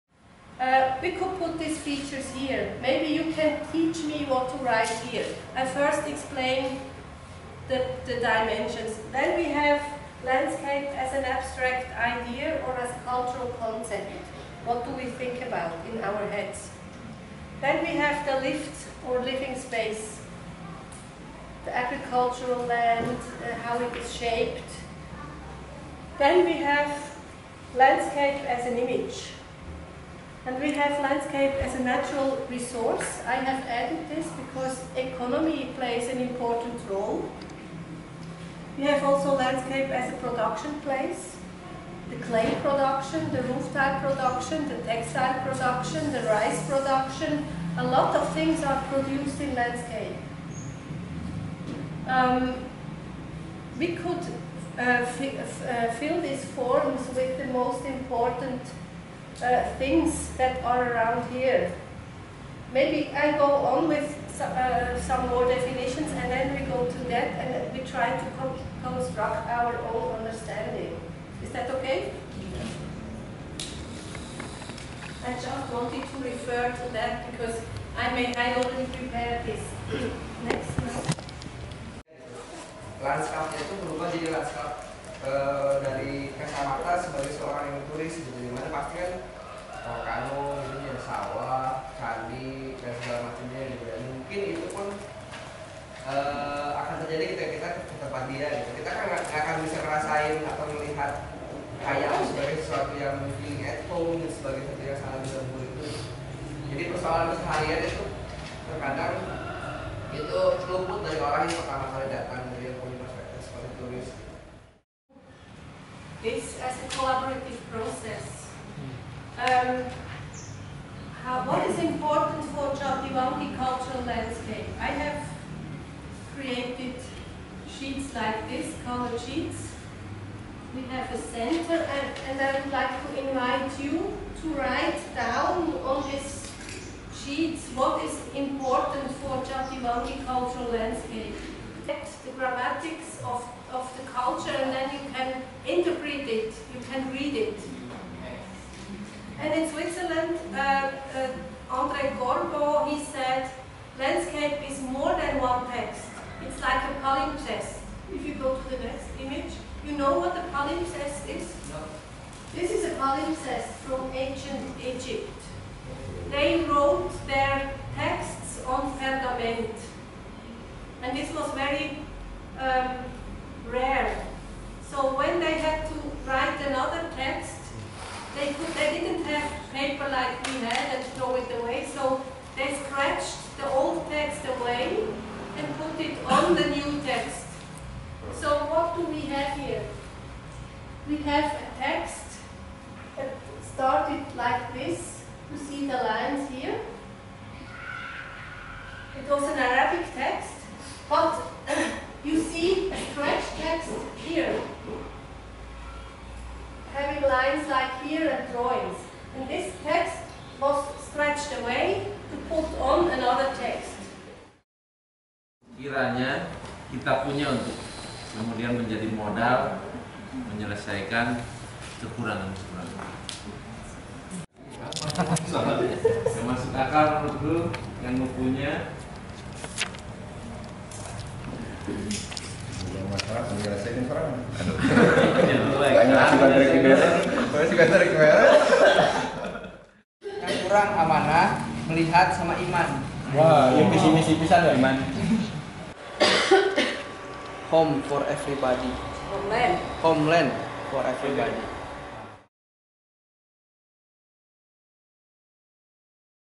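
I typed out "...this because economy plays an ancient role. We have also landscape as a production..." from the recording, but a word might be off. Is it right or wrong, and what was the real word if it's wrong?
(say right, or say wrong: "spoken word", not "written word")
wrong: "important", not "ancient".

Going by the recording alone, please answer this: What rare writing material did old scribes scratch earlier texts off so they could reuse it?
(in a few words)
pergament.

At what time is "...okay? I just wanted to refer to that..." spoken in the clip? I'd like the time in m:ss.
1:11.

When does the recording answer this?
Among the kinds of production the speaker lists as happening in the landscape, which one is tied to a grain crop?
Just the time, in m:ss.
0:46.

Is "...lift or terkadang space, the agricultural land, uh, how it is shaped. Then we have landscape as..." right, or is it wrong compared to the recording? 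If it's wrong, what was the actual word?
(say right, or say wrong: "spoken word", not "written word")
wrong: "living", not "terkadang".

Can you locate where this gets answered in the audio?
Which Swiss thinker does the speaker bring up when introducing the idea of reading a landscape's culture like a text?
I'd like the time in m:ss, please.
2:31.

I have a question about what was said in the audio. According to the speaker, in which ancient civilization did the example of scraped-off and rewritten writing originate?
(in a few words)
ancient Egypt.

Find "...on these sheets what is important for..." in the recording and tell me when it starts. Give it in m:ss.
2:15.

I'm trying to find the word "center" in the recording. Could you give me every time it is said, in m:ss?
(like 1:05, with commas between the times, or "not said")
2:11.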